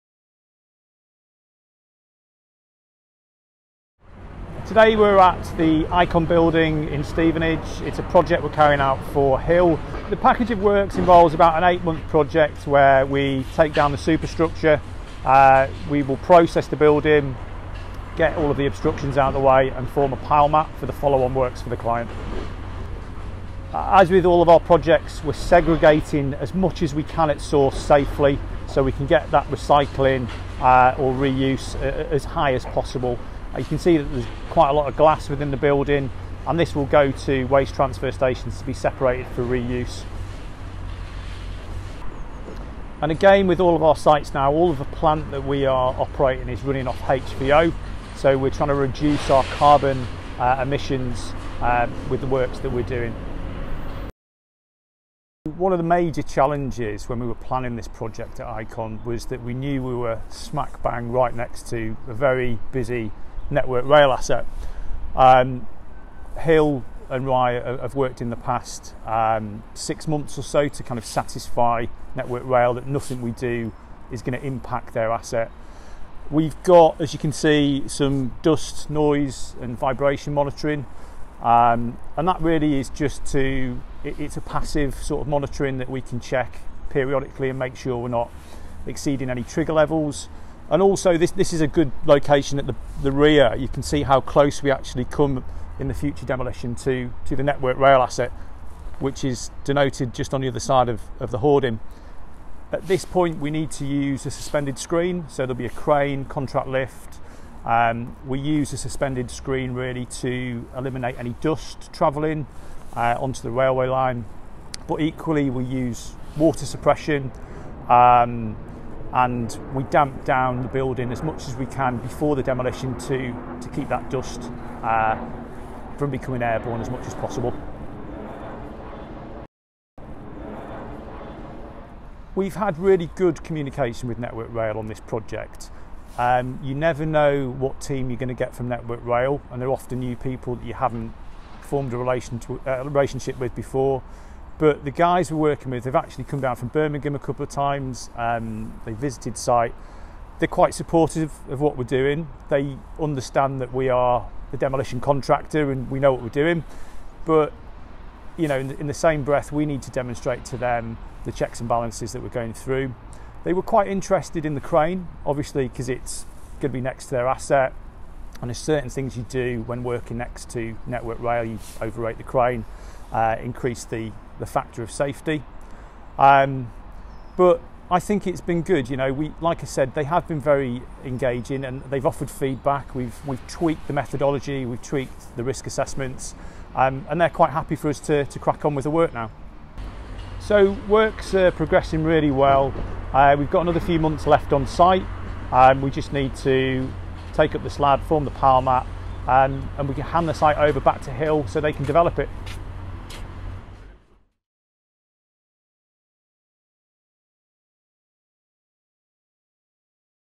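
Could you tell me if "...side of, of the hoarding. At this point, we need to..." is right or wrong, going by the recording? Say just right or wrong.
right.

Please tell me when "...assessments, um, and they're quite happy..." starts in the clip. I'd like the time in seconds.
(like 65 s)
185 s.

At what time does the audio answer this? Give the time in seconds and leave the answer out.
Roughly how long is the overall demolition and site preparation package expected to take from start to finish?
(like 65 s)
11 s.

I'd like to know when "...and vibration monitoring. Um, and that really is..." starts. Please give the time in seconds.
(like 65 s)
79 s.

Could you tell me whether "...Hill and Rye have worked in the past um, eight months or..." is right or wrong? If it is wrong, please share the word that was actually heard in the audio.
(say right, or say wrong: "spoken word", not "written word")
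wrong: "six", not "eight".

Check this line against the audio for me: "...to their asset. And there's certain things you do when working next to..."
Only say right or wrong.
right.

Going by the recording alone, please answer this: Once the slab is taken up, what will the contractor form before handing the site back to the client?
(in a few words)
pile mat.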